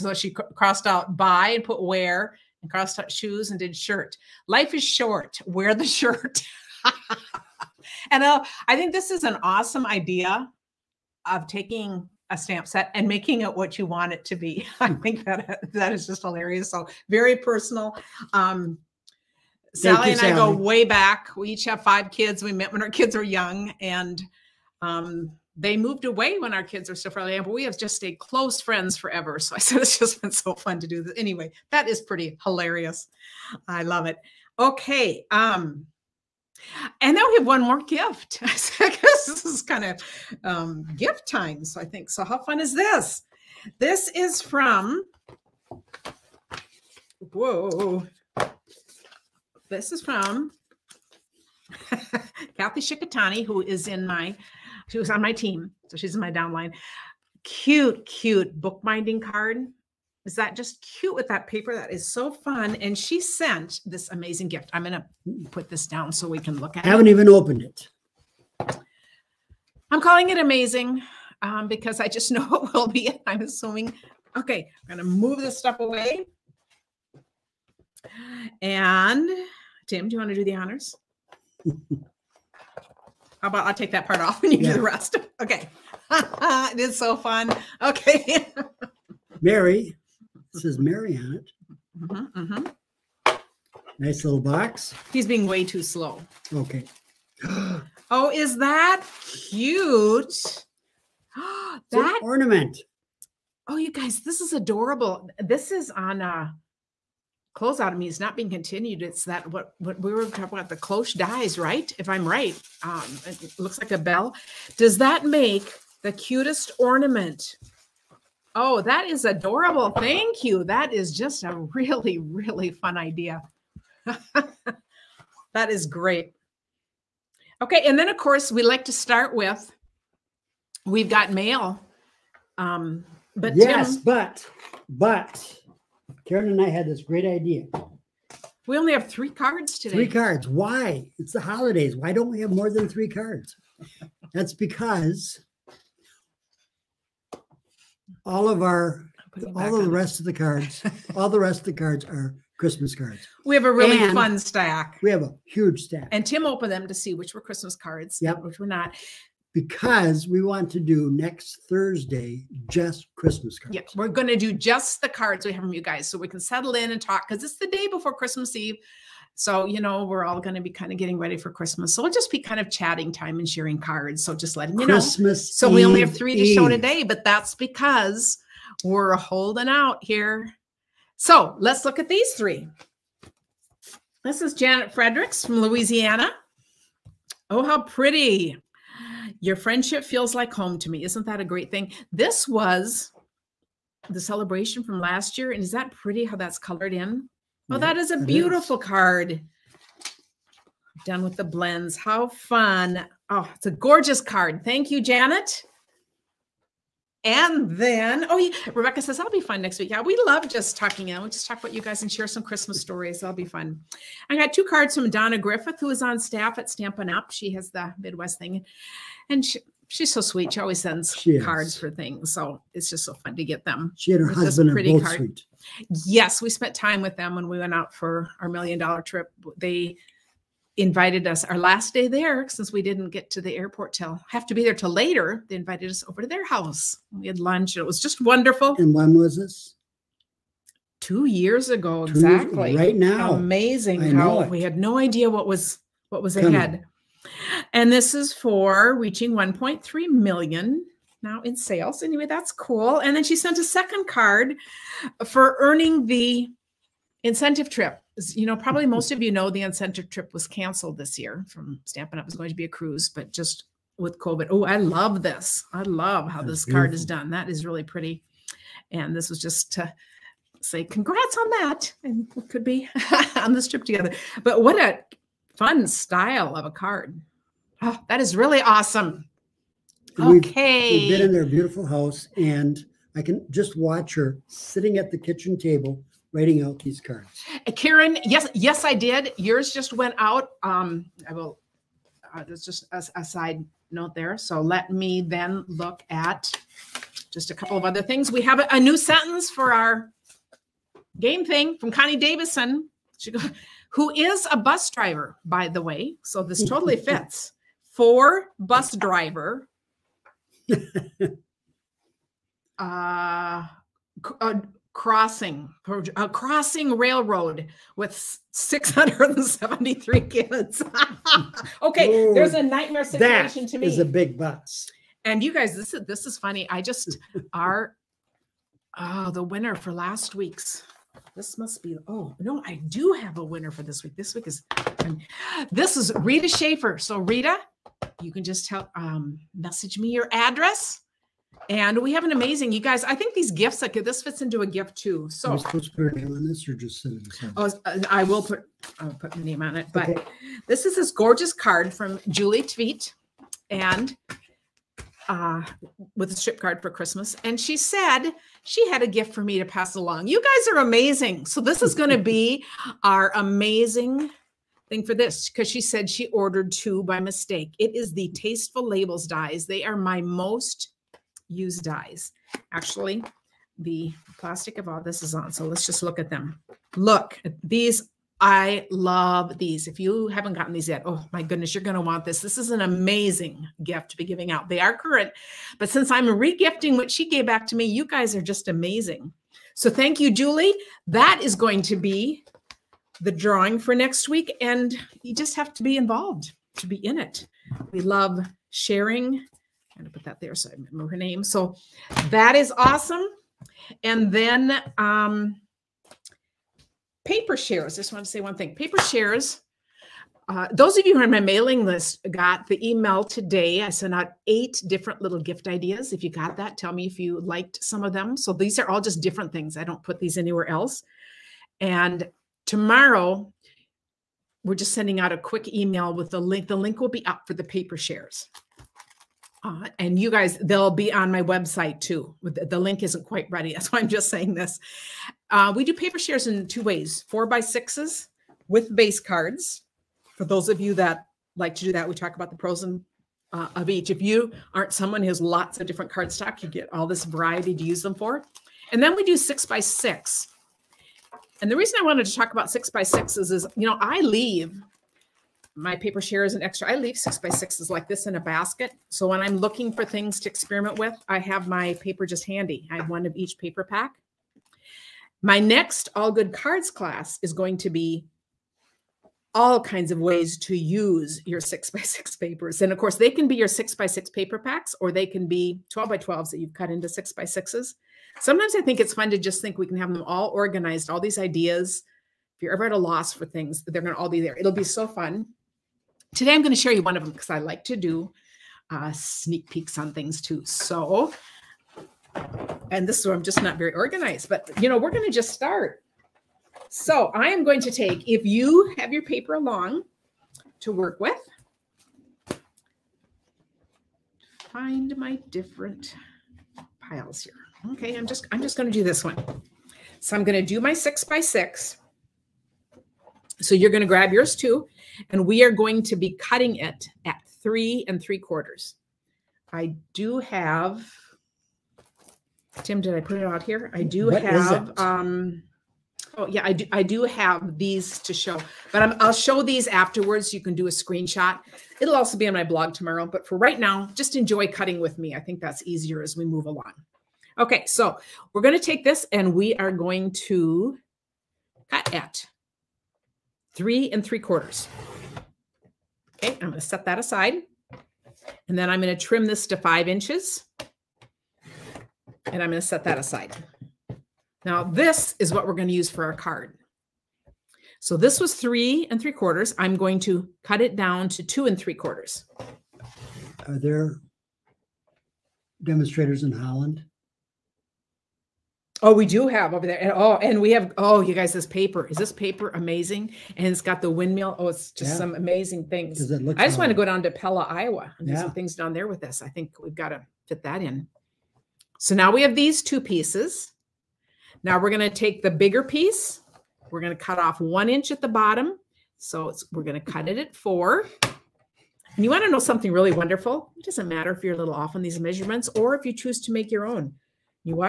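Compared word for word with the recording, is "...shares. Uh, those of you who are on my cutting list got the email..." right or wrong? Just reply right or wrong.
wrong.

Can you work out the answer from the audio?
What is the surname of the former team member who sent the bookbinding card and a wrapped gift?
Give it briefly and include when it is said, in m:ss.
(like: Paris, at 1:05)
Shikatani, at 0:52.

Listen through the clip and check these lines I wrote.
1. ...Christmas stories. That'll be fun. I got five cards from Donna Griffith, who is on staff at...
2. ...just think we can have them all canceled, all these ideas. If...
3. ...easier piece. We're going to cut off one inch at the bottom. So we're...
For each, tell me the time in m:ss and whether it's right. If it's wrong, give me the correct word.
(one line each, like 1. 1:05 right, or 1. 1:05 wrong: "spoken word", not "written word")
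1. 3:32 wrong: "two", not "five"
2. 7:59 wrong: "organized", not "canceled"
3. 9:45 wrong: "bigger", not "easier".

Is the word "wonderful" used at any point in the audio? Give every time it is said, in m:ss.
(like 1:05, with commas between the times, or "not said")
3:58, 9:53.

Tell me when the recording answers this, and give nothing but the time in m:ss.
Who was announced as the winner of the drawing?
5:36.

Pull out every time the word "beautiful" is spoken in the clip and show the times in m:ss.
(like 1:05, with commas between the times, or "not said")
3:18, 4:26, 4:41.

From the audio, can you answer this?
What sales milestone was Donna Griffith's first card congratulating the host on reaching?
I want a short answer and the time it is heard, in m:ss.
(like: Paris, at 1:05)
1.3 million, at 4:09.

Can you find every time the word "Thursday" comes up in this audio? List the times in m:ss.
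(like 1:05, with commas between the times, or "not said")
2:41.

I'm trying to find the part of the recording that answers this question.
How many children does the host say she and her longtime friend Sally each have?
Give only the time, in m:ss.
0:21.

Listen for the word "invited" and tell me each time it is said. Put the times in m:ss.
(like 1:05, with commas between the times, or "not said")
3:50, 3:55.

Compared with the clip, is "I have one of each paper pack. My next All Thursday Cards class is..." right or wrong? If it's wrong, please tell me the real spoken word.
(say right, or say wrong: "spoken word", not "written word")
wrong: "Good", not "Thursday".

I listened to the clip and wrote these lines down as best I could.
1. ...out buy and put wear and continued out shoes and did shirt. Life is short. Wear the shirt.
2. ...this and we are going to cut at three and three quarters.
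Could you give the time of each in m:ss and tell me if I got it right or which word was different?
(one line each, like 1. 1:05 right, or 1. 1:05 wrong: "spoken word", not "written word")
1. 0:00 wrong: "crossed", not "continued"
2. 8:59 right.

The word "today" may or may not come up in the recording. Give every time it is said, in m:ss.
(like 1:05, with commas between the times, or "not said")
2:19, 2:56, 6:53, 8:06.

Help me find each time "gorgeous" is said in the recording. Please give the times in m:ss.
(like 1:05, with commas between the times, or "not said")
3:23, 5:51.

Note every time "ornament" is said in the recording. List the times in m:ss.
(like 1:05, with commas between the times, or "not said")
1:42, 1:56.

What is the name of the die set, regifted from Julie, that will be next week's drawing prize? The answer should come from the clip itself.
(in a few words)
Tasteful Labels.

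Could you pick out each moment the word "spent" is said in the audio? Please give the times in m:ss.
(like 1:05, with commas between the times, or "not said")
3:46.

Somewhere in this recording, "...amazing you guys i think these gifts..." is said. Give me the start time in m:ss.
5:42.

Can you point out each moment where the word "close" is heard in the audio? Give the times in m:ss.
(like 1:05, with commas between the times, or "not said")
0:28, 1:47.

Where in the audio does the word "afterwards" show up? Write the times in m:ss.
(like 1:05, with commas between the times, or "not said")
8:49.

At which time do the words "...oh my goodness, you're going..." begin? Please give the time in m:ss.
6:21.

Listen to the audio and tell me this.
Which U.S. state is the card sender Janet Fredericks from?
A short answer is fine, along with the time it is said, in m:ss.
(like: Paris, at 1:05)
Louisiana, at 3:05.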